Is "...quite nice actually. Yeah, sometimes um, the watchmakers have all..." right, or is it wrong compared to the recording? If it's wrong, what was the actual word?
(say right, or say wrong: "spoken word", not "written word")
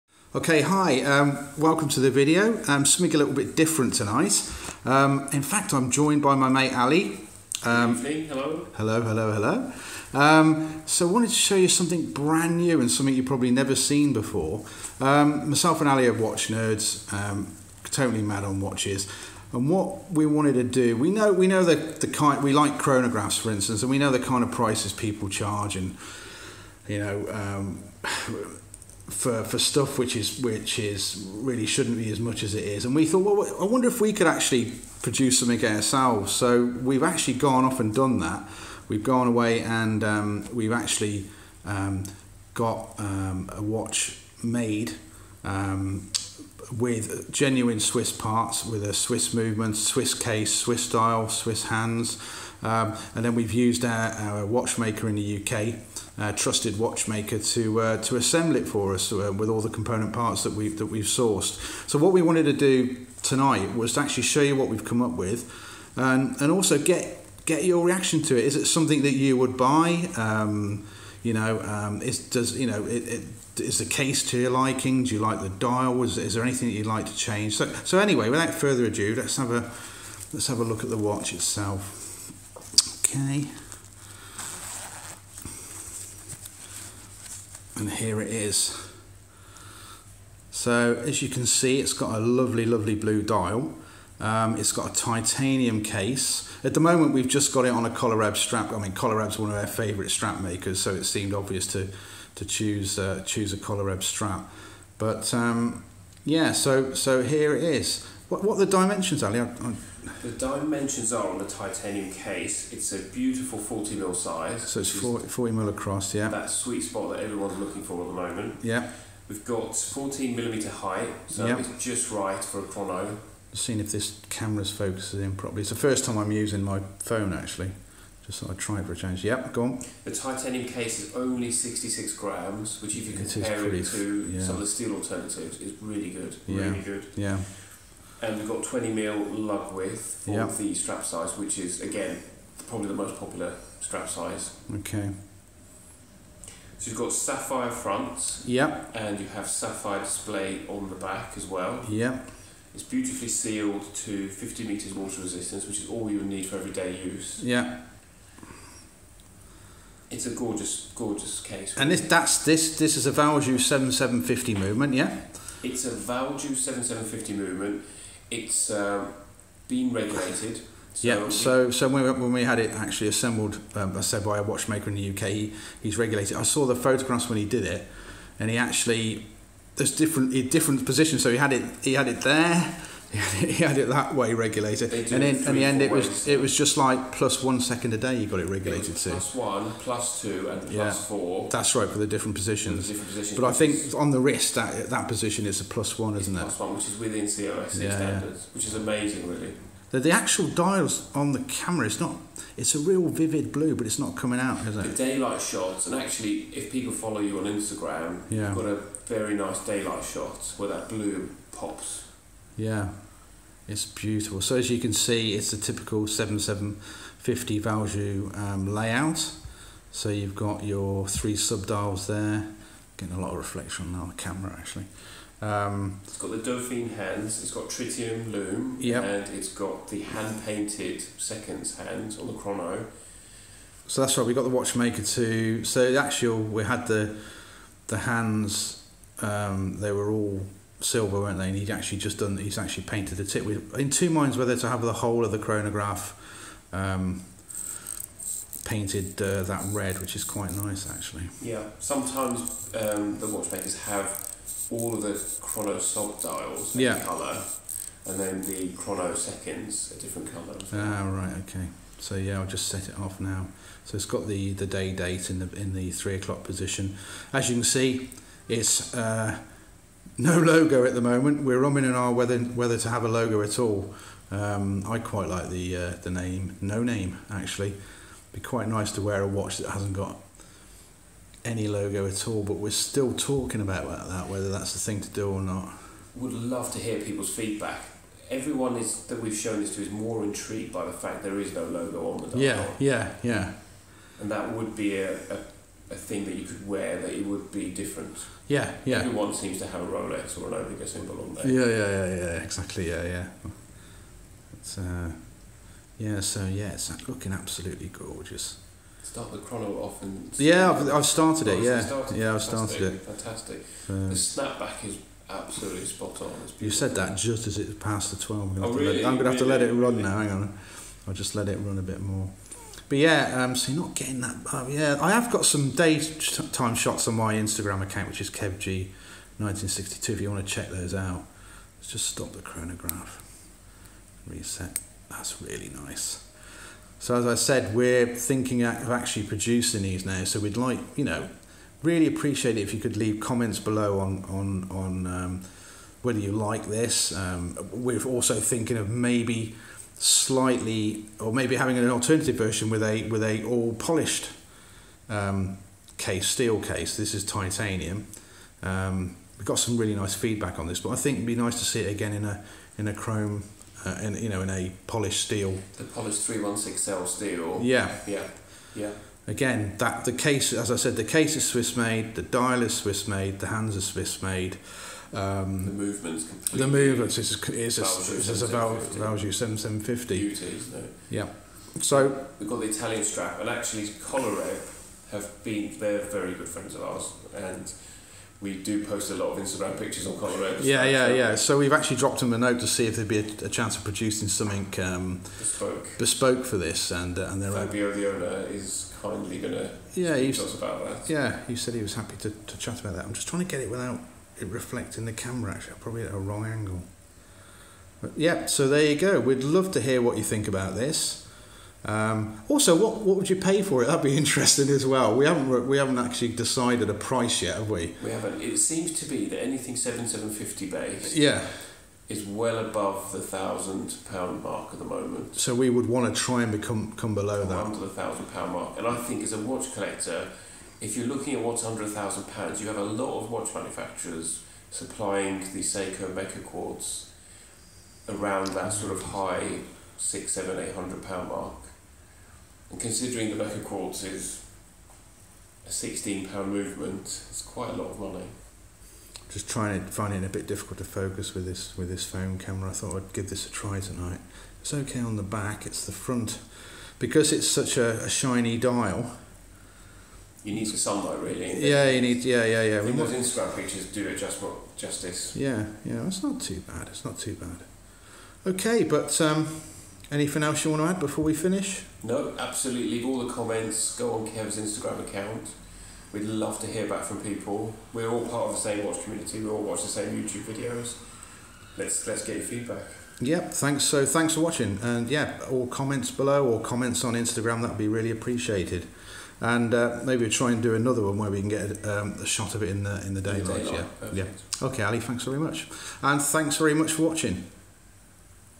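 right.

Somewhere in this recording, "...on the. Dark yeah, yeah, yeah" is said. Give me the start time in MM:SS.
04:52.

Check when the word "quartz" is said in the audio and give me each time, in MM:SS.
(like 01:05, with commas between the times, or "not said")
07:16, 07:23.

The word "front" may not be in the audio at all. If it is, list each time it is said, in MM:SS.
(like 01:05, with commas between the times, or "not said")
02:27, 07:35.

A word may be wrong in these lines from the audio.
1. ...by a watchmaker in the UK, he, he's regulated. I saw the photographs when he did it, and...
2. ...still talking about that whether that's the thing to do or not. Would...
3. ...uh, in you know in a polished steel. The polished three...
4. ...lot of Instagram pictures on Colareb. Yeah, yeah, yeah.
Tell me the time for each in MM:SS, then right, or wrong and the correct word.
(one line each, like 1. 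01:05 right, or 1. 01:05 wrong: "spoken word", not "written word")
1. 02:54 right
2. 04:42 right
3. 06:03 right
4. 06:29 right.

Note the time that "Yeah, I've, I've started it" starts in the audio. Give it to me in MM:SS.
05:10.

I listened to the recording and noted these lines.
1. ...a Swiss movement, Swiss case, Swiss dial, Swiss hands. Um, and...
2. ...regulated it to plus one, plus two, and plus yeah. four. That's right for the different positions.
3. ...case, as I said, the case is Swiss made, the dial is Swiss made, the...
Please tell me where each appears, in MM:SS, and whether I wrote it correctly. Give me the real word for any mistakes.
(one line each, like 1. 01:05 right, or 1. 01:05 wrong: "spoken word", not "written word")
1. 00:48 right
2. 03:08 right
3. 06:10 right.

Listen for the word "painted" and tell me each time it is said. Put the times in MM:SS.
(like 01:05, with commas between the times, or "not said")
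03:50, 04:02, 04:08.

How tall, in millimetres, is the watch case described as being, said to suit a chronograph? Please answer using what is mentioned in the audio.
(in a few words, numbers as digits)
14 mm.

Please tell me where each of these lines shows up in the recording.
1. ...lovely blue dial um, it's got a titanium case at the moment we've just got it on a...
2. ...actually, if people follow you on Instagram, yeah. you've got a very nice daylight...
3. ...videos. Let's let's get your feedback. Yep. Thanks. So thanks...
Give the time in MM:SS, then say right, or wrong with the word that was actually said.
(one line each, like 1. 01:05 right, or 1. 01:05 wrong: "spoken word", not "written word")
1. 01:32 right
2. 03:26 right
3. 08:00 right.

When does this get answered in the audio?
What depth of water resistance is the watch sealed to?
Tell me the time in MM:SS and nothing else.
02:34.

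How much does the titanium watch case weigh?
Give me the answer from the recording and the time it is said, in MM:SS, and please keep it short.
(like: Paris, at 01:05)
66 grams, at 02:11.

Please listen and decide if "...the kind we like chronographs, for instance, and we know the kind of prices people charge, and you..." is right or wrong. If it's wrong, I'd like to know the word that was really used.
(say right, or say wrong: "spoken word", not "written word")
right.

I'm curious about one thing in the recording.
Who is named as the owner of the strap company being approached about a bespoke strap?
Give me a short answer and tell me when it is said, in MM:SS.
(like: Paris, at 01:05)
Fabio, at 06:37.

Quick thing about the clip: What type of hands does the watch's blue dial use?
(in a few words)
Dauphine.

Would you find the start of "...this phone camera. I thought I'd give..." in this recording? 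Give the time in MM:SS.
07:31.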